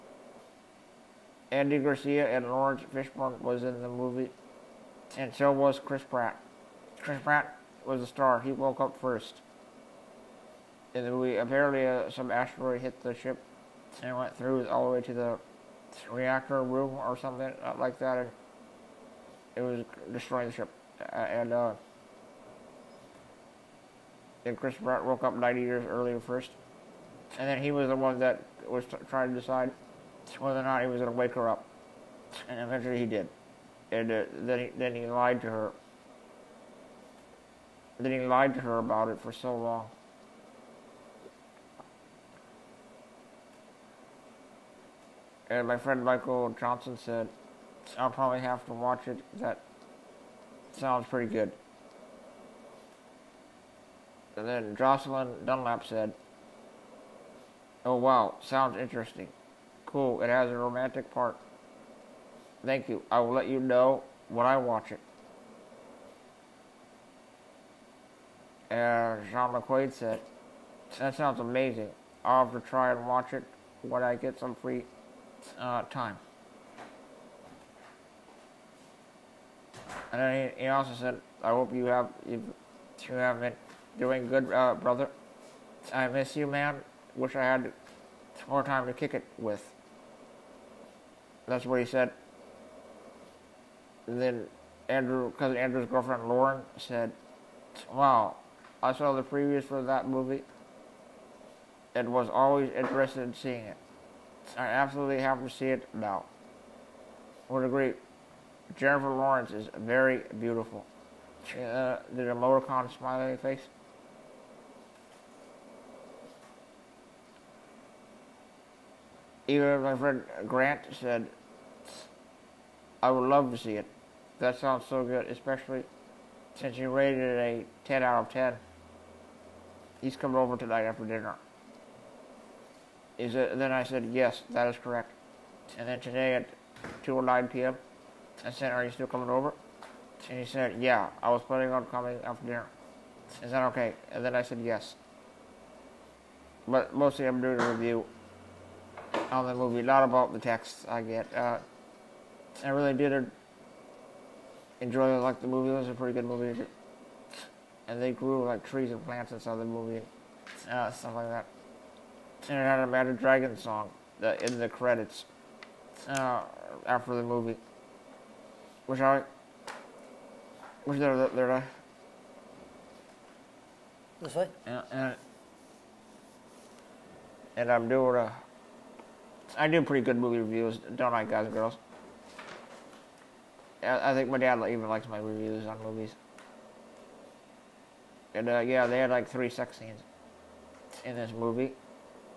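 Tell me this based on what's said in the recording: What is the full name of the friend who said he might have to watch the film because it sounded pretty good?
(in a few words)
Michael Johnson.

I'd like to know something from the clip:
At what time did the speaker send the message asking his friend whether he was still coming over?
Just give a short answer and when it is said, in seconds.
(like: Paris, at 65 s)
2:09 p.m., at 137 s.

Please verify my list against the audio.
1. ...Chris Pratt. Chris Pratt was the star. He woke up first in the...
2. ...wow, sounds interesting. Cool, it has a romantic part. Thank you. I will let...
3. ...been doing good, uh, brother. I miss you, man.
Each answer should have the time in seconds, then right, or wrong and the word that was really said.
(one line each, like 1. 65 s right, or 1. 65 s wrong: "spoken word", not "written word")
1. 5 s right
2. 57 s right
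3. 83 s right.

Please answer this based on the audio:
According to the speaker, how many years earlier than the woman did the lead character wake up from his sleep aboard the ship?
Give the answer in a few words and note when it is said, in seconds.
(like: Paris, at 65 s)
90, at 25 s.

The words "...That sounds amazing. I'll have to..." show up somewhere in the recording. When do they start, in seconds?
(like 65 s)
71 s.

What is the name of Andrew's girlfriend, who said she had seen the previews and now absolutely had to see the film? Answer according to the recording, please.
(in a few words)
Lauren.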